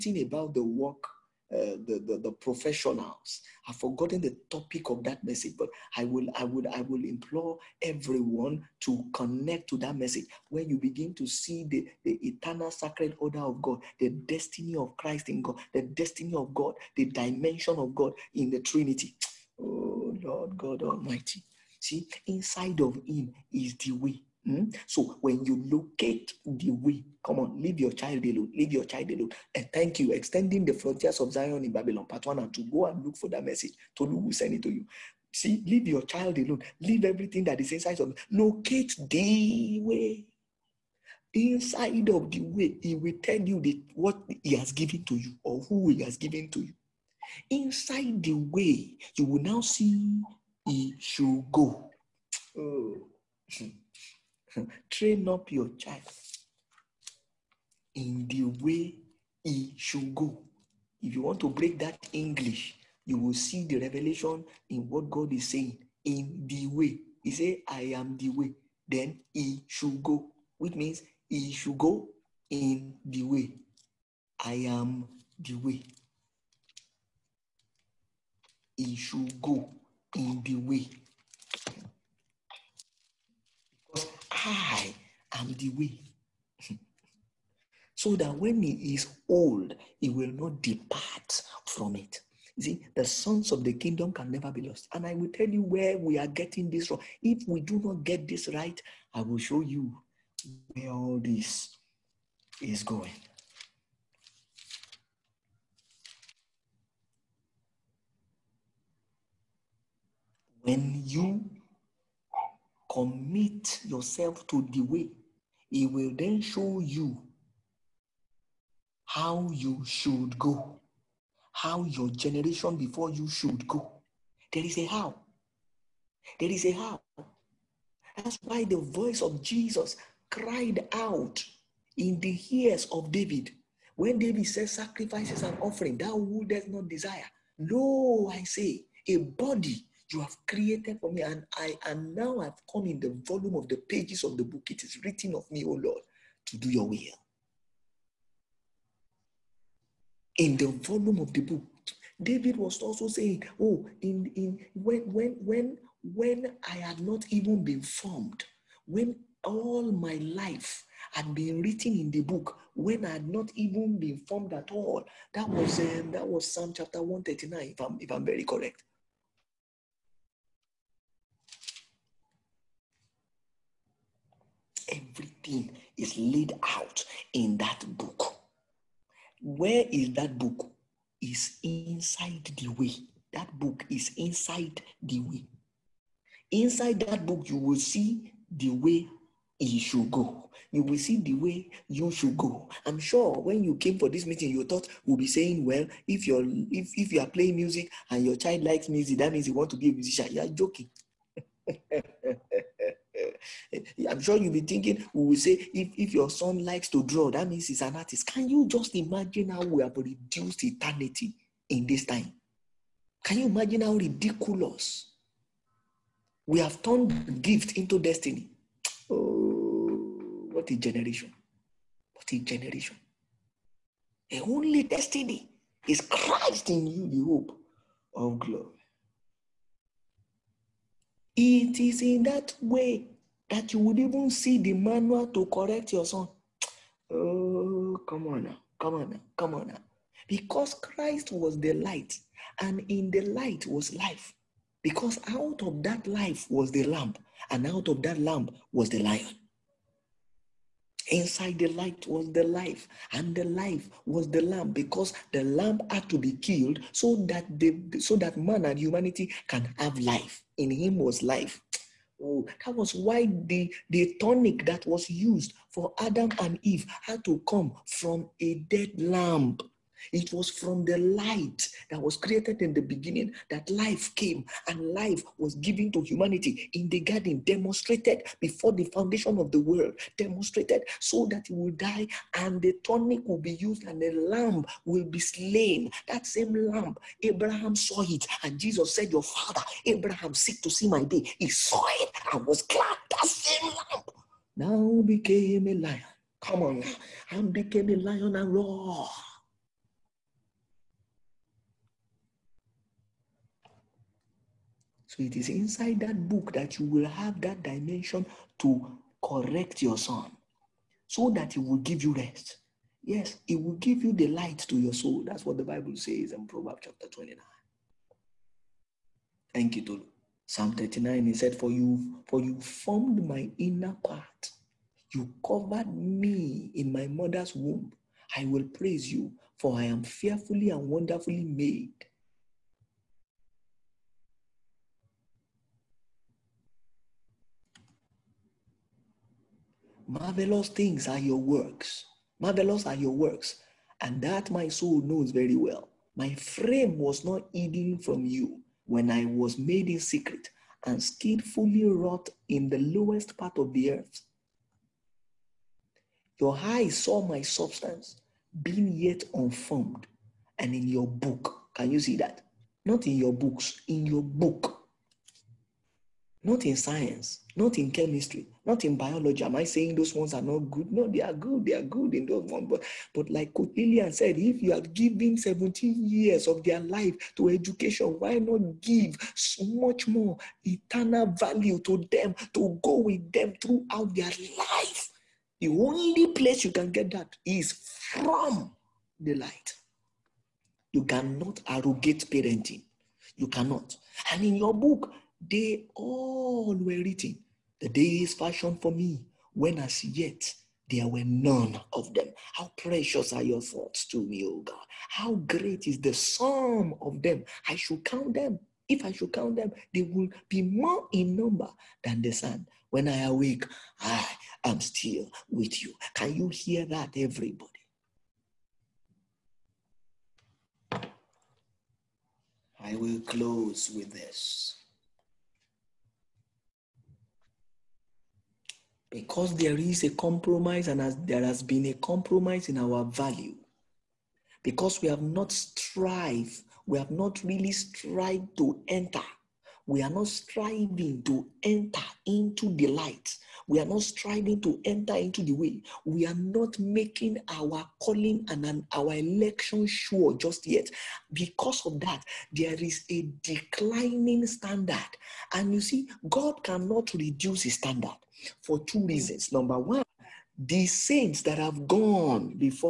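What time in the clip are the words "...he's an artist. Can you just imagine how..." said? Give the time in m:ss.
3:27.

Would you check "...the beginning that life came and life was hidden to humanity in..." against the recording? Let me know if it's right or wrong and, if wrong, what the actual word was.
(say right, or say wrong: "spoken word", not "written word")
wrong: "given", not "hidden".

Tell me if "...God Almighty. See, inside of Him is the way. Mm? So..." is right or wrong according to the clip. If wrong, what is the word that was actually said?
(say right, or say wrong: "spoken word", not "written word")
right.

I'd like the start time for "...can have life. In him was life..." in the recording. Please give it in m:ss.
4:19.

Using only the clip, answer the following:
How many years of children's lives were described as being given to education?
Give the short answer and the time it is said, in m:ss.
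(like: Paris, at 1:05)
17, at 6:15.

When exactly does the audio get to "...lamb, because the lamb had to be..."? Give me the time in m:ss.
4:14.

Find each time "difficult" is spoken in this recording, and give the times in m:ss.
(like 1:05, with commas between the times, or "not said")
not said.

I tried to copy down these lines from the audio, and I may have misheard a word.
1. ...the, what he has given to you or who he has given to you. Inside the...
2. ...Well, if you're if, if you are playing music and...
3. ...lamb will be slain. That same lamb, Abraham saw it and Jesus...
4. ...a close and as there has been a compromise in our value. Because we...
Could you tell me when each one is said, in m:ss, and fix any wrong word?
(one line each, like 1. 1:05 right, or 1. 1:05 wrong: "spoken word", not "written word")
1. 0:43 right
2. 3:15 right
3. 4:44 right
4. 7:10 wrong: "compromise", not "close".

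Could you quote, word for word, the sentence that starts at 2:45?
That was um, that was Psalm chapter 139, if I'm if I'm very correct.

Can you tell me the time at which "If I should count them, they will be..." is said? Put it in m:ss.
6:48.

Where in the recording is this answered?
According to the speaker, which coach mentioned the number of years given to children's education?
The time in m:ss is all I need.
6:13.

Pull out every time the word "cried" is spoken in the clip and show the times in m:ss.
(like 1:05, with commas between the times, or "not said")
2:10.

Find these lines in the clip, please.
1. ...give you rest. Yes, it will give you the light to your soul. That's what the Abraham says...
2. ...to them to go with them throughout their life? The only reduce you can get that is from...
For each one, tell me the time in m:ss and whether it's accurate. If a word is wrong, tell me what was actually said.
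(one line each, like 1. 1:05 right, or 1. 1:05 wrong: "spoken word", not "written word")
1. 5:11 wrong: "Bible", not "Abraham"
2. 6:21 wrong: "place", not "reduce".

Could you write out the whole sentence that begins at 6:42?
How precious are your thoughts to me, O God.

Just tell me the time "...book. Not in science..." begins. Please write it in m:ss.
6:04.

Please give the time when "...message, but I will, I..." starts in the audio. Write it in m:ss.
0:05.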